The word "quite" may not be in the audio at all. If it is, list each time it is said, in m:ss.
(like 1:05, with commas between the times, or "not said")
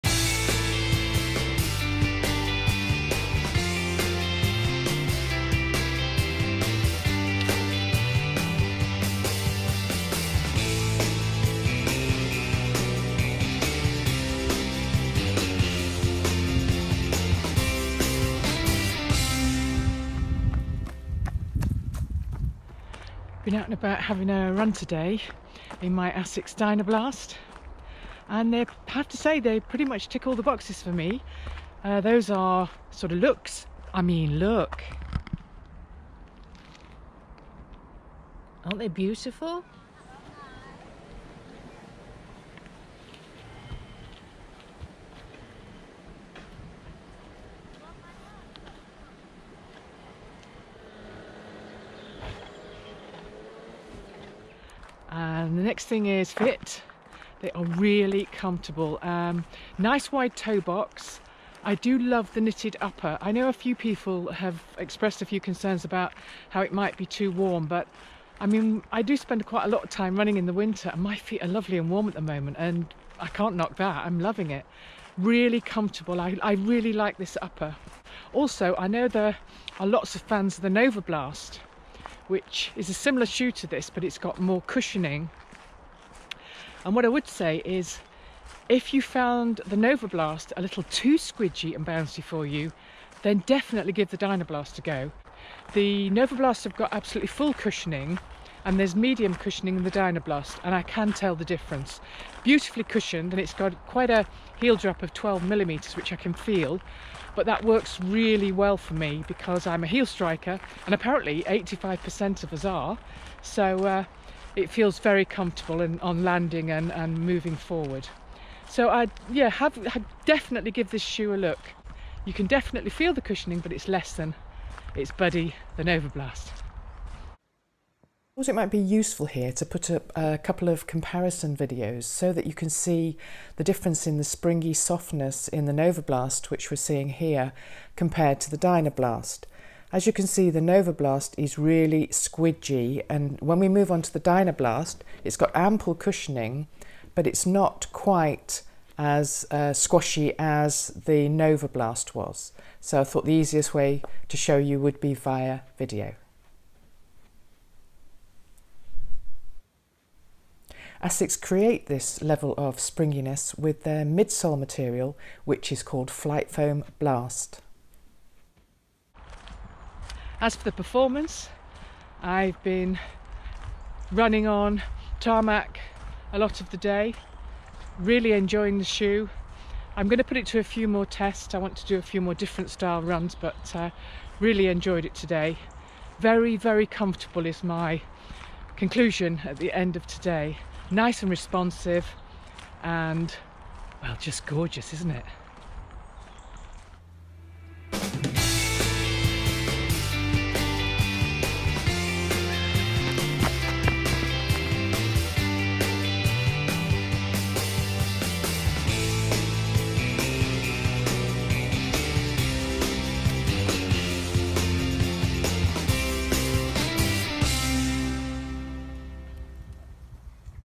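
1:09, 1:43, 2:27.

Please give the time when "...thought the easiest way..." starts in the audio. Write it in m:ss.
2:33.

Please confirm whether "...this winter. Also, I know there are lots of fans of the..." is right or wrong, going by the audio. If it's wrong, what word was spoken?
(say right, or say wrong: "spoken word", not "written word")
wrong: "upper", not "winter".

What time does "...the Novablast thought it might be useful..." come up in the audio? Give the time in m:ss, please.
2:05.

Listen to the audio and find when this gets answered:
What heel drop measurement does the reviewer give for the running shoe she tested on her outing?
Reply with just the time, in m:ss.
1:45.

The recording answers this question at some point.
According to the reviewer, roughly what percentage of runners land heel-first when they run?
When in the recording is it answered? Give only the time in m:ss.
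1:51.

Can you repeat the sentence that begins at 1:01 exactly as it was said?
I do love the knitted upper.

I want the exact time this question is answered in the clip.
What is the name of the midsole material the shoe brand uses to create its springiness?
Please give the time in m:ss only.
2:46.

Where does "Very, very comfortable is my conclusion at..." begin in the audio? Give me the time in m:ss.
3:06.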